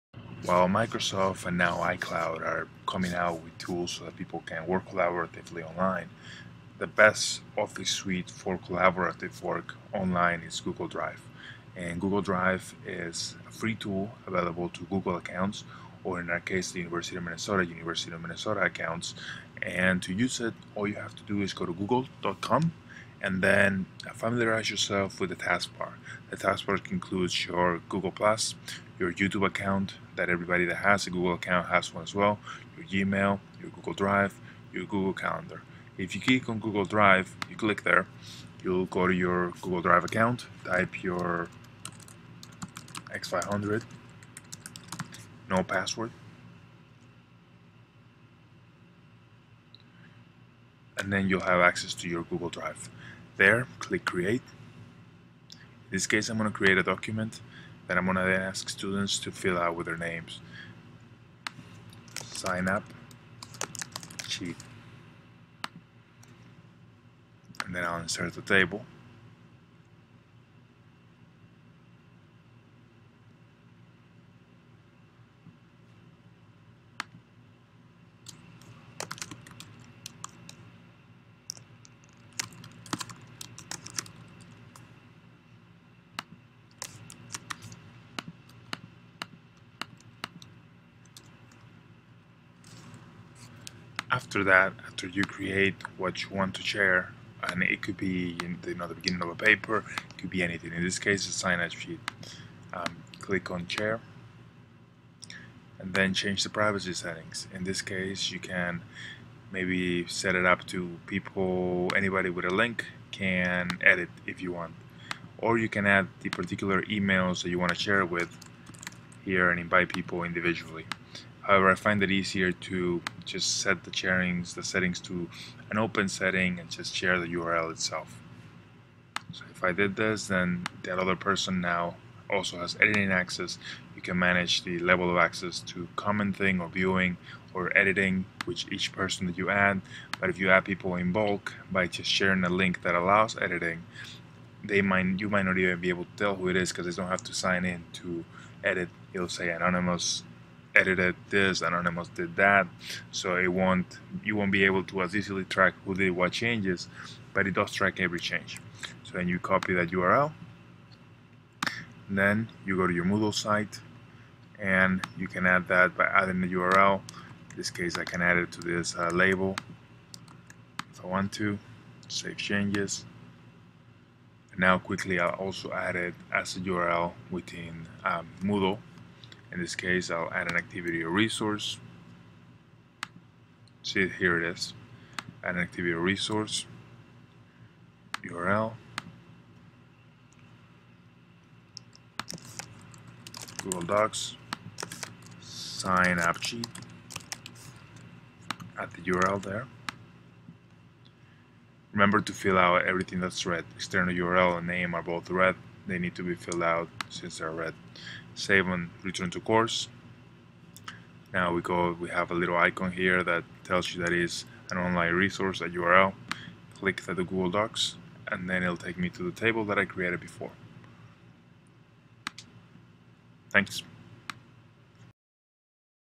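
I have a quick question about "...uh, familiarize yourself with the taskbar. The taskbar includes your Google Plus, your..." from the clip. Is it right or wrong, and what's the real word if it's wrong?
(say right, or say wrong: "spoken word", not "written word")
right.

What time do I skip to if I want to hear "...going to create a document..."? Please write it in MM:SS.
00:56.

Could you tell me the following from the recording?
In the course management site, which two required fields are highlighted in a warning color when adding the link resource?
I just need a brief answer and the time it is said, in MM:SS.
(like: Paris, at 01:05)
External URL and name, at 03:23.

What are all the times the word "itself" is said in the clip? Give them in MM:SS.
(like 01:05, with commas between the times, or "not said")
02:07.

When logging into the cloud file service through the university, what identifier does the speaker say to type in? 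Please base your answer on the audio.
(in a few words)
X500.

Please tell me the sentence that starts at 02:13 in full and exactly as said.
You can manage the level of access to commenting or viewing or editing, which each person that you add.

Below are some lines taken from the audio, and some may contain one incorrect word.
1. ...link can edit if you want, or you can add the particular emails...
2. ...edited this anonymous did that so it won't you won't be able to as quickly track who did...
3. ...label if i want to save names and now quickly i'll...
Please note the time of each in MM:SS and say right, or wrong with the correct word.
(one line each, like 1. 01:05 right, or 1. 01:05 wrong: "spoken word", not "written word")
1. 01:52 right
2. 02:30 wrong: "easily", not "quickly"
3. 02:49 wrong: "changes", not "names".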